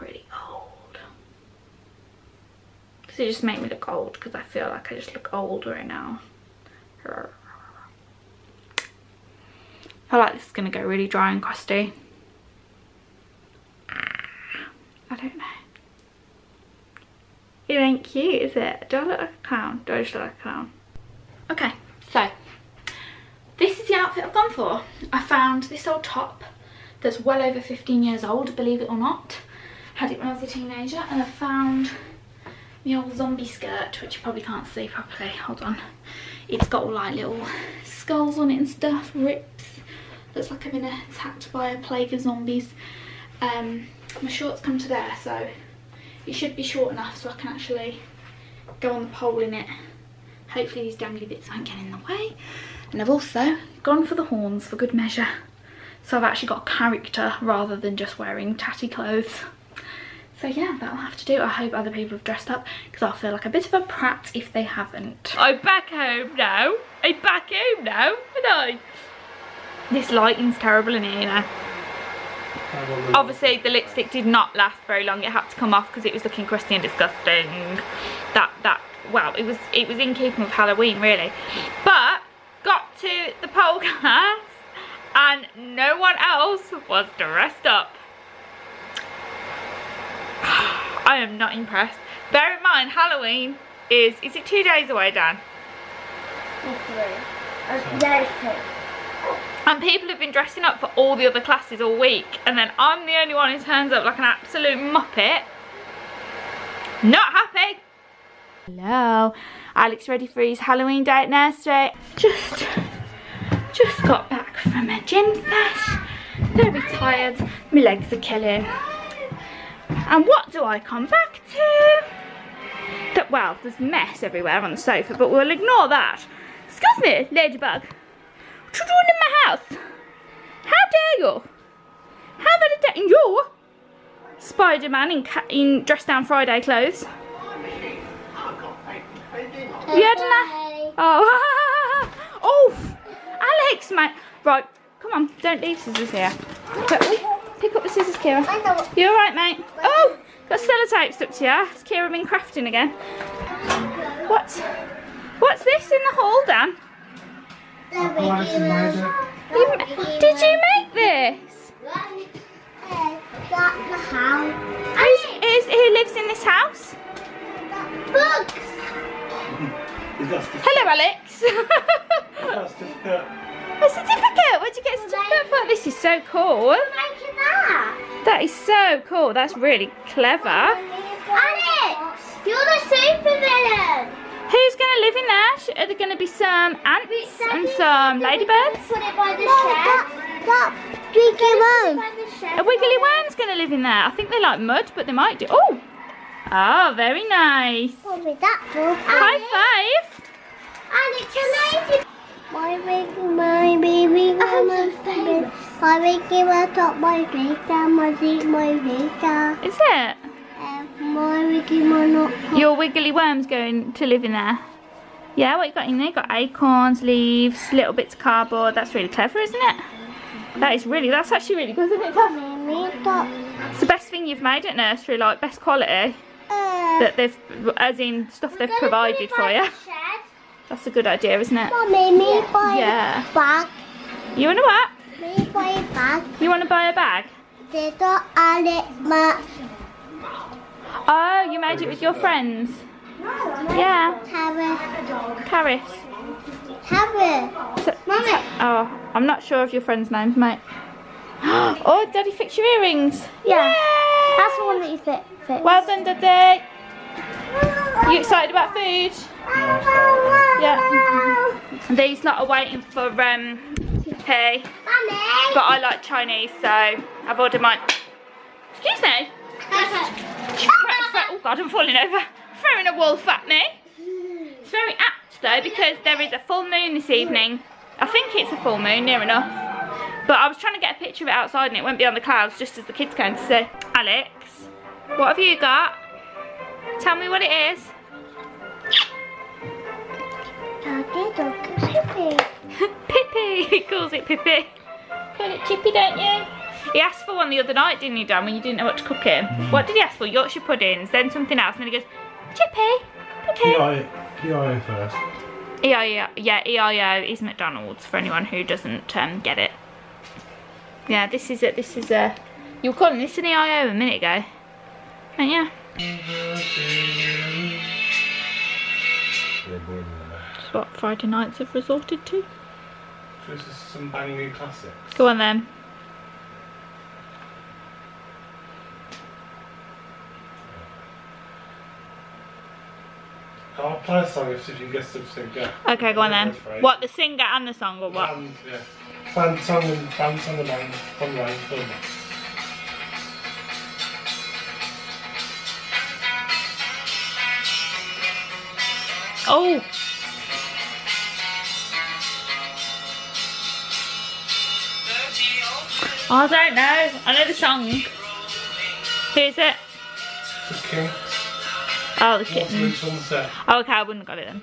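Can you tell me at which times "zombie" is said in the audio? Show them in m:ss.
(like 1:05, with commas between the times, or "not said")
0:33, 0:42.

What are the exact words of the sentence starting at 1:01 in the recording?
I hope other people have dressed up because I'll feel like a bit of a prat if they haven't.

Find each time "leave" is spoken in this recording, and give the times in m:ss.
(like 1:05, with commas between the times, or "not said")
2:25, 3:37.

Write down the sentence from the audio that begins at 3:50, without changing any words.
That's a good idea, isn't it?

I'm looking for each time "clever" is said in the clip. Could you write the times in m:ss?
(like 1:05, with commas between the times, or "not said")
3:00, 3:39.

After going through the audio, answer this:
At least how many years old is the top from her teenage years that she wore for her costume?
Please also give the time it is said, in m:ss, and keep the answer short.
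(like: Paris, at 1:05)
15, at 0:27.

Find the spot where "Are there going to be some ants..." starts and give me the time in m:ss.
3:05.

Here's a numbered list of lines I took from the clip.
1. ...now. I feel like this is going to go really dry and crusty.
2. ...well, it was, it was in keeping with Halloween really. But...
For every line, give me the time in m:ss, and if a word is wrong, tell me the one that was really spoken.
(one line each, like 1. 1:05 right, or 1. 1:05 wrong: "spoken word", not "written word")
1. 0:05 right
2. 1:19 right.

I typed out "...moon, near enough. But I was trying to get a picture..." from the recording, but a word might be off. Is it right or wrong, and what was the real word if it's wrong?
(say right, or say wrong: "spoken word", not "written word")
right.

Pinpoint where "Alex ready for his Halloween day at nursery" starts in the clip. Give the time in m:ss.
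1:49.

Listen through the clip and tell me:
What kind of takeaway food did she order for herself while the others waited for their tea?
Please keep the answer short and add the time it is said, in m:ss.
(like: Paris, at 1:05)
Chinese, at 4:26.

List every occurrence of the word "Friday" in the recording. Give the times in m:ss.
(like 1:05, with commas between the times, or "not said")
2:16, 5:20.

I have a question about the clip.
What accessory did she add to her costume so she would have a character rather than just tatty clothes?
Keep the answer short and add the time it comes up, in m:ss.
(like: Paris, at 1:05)
Horns, at 0:54.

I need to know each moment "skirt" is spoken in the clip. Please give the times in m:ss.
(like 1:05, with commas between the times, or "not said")
0:33.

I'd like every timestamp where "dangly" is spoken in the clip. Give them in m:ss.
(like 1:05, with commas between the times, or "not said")
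0:50.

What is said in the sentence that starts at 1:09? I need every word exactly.
This lighting's terrible in here Obviously the lipstick did not last very long.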